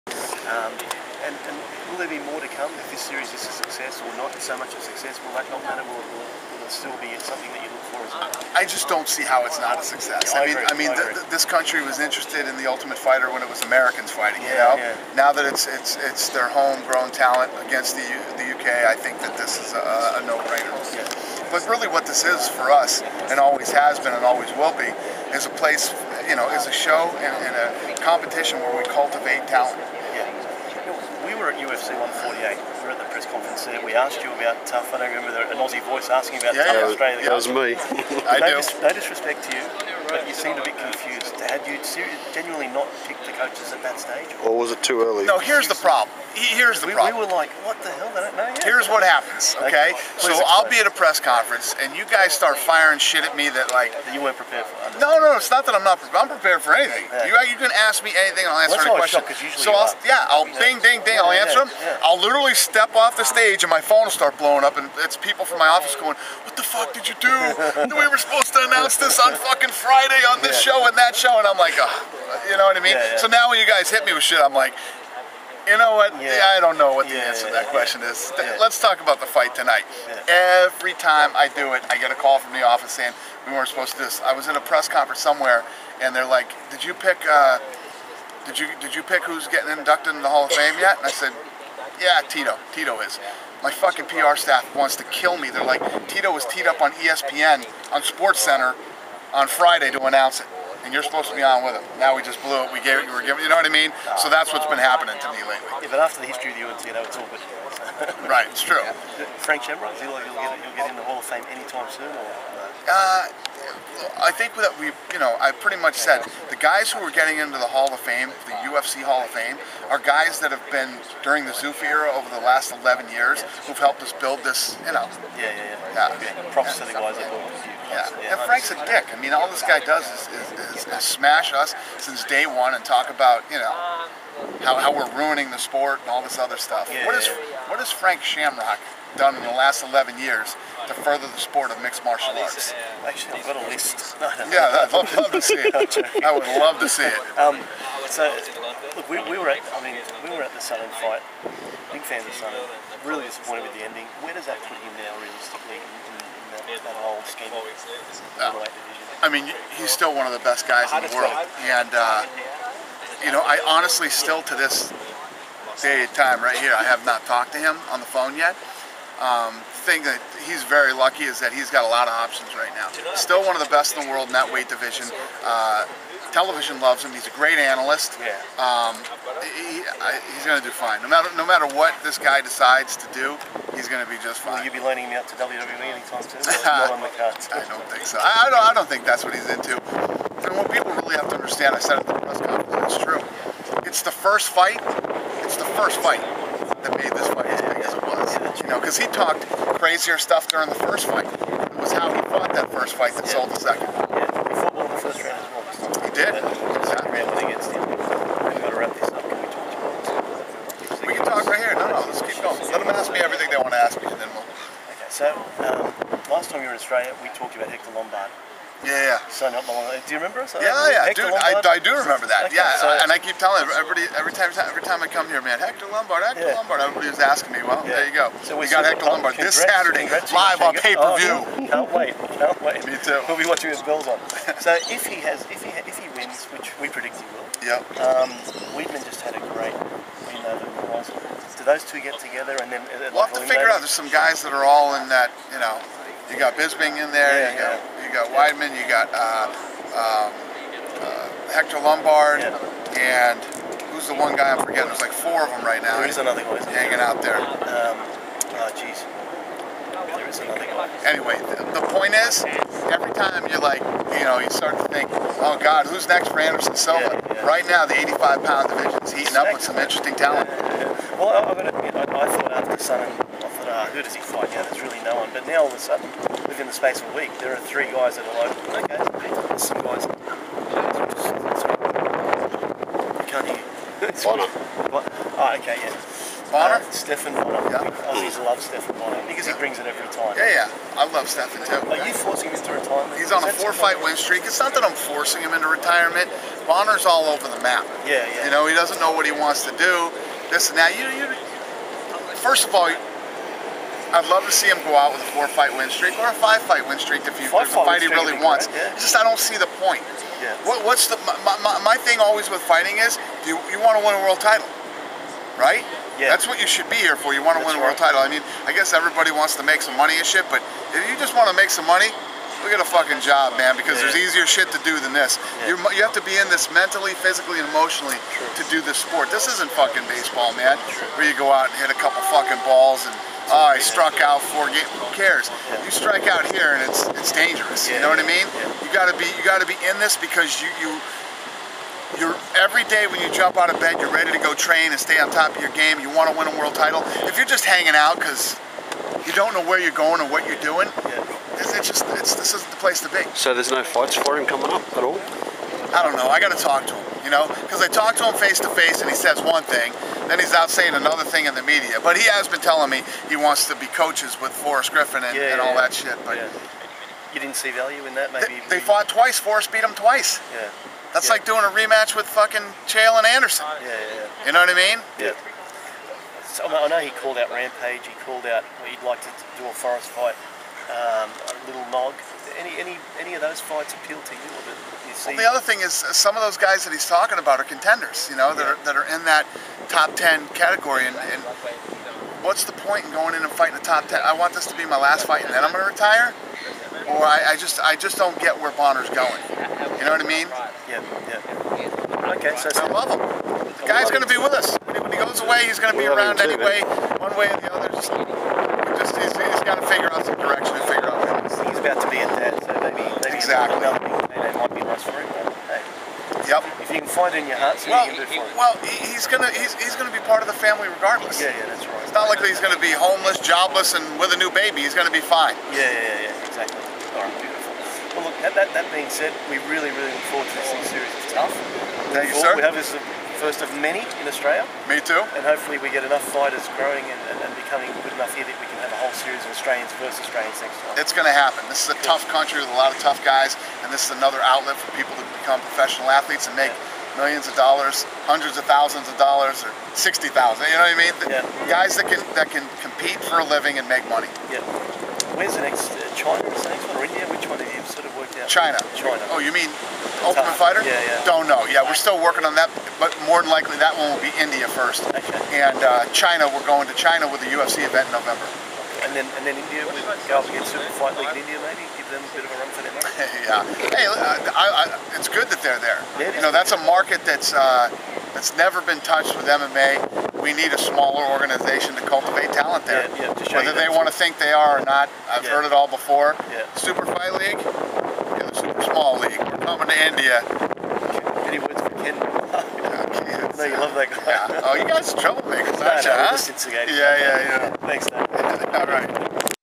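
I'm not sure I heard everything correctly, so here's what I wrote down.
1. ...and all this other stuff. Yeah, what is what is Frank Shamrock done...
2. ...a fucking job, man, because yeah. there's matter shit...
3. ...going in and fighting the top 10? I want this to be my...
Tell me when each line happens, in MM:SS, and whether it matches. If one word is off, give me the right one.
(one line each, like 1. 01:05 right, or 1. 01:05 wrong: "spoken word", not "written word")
1. 02:16 right
2. 05:22 wrong: "easier", not "matter"
3. 06:33 right.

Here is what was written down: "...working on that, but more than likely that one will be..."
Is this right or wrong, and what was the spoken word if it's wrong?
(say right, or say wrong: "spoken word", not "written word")
right.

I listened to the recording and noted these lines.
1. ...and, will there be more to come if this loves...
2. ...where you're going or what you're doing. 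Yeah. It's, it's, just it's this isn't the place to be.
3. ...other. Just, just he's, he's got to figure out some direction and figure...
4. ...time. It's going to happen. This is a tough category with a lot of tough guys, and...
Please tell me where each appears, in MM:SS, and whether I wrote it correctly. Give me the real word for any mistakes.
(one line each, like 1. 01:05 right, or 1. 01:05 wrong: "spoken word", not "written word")
1. 00:01 wrong: "series", not "loves"
2. 05:49 right
3. 06:47 right
4. 07:20 wrong: "country", not "category".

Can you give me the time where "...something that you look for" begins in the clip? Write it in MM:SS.
00:07.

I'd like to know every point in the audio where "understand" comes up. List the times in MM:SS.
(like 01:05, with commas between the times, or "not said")
03:11.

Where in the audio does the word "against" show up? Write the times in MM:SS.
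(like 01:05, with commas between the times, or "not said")
00:17, 03:27, 07:50.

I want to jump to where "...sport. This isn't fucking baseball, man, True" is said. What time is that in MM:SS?
05:29.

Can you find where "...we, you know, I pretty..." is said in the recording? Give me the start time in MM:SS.
01:54.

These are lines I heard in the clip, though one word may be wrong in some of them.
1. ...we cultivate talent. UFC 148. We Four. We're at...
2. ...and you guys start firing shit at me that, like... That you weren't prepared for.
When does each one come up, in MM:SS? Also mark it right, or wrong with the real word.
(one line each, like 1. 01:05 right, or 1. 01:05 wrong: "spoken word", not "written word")
1. 00:28 wrong: "Eight", not "Four"
2. 00:51 right.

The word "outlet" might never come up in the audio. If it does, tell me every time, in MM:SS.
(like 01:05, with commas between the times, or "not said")
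07:24.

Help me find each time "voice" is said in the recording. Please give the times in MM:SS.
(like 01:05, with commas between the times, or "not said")
00:35.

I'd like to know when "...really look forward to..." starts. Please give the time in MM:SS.
07:09.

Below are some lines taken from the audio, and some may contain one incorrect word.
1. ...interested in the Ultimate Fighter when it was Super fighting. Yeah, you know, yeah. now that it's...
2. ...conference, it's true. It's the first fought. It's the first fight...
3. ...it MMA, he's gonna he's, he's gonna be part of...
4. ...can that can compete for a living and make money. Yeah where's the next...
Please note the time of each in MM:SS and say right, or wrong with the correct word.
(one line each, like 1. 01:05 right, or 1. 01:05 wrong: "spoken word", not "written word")
1. 00:12 wrong: "Americans", not "Super"
2. 03:12 wrong: "fight", not "fought"
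3. 06:58 wrong: "Well", not "MMA"
4. 07:32 right.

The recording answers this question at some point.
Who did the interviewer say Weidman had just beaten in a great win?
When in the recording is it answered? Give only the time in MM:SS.
04:00.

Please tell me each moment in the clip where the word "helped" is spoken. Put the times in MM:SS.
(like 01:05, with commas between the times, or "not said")
02:03.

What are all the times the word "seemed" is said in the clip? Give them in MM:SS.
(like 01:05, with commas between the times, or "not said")
00:40.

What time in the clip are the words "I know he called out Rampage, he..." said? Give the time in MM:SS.
06:16.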